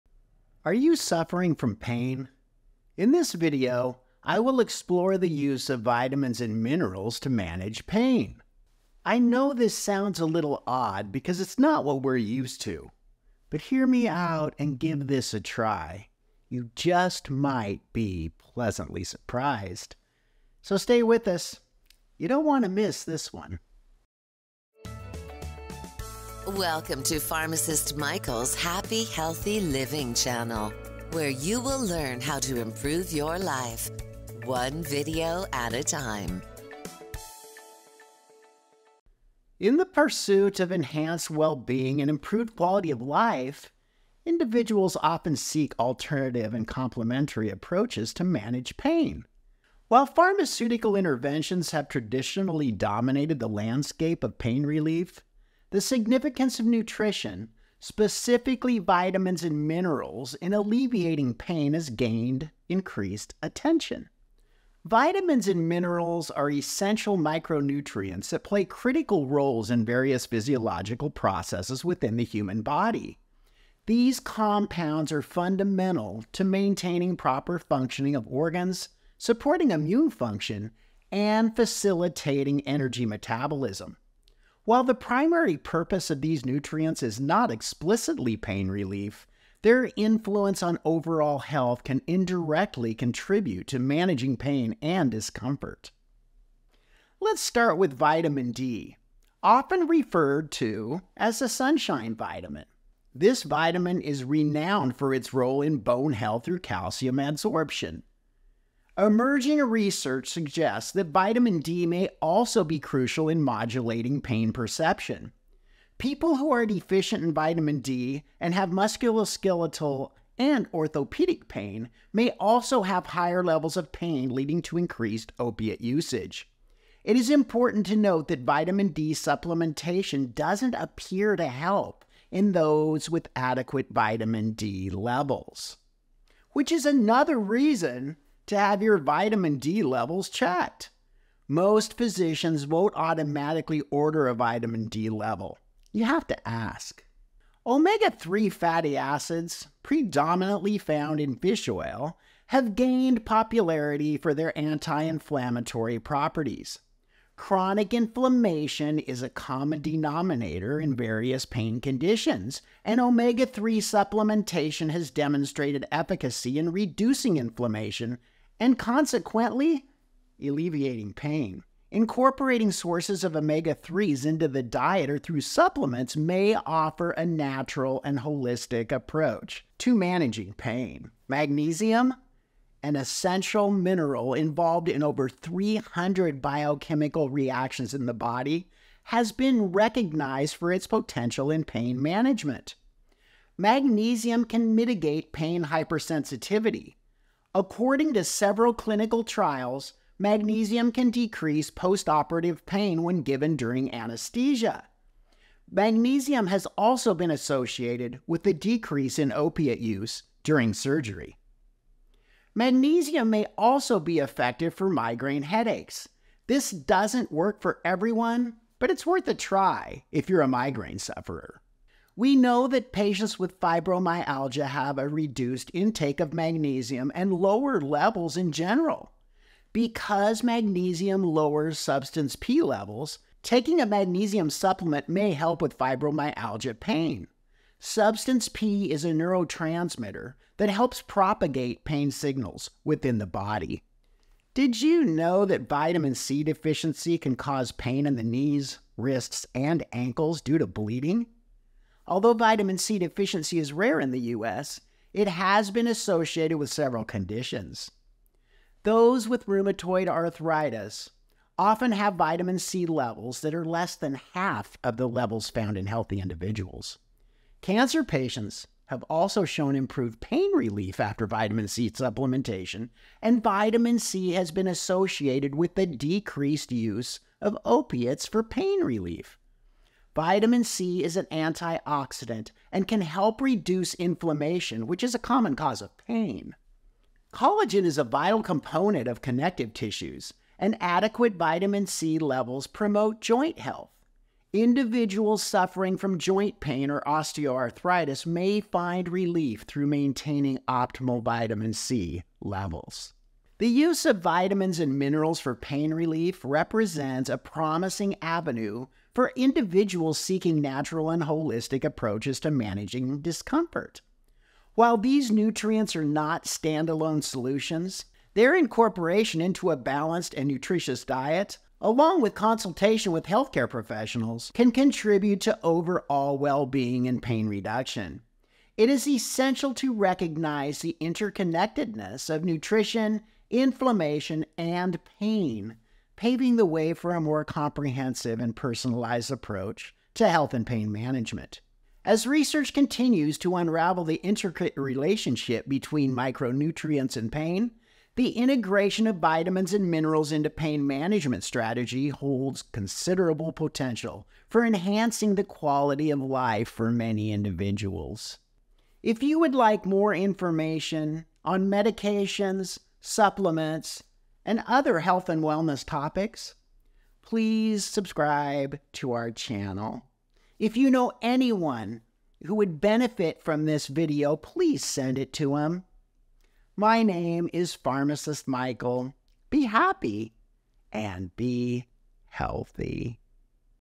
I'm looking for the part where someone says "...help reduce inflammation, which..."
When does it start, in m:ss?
4:42.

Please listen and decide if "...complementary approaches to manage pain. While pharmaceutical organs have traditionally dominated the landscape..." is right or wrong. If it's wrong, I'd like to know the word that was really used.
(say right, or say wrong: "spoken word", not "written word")
wrong: "interventions", not "organs".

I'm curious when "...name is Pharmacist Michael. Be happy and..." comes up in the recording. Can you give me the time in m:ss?
6:17.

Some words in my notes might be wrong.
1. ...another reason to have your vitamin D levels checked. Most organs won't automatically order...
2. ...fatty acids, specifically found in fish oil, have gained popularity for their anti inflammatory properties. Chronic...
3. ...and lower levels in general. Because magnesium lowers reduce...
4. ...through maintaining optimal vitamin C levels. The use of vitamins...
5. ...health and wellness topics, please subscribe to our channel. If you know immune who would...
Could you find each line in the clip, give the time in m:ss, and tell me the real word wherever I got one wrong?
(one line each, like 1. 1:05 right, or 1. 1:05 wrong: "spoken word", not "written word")
1. 2:16 wrong: "physicians", not "organs"
2. 2:28 wrong: "predominantly", not "specifically"
3. 3:47 wrong: "substance", not "reduce"
4. 4:59 right
5. 6:04 wrong: "anyone", not "immune".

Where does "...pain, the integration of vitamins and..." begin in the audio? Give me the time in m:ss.
5:47.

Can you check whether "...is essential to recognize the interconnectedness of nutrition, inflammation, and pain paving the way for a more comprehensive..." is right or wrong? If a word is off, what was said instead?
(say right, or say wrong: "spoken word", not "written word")
right.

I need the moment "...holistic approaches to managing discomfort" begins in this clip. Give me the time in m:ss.
5:11.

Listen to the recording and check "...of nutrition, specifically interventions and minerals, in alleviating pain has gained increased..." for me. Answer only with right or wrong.
wrong.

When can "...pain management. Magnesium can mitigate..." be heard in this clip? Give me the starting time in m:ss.
3:11.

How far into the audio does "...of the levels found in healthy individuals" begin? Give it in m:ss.
4:24.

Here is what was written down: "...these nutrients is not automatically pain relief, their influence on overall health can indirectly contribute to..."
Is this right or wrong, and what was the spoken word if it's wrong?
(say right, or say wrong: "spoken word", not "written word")
wrong: "explicitly", not "automatically".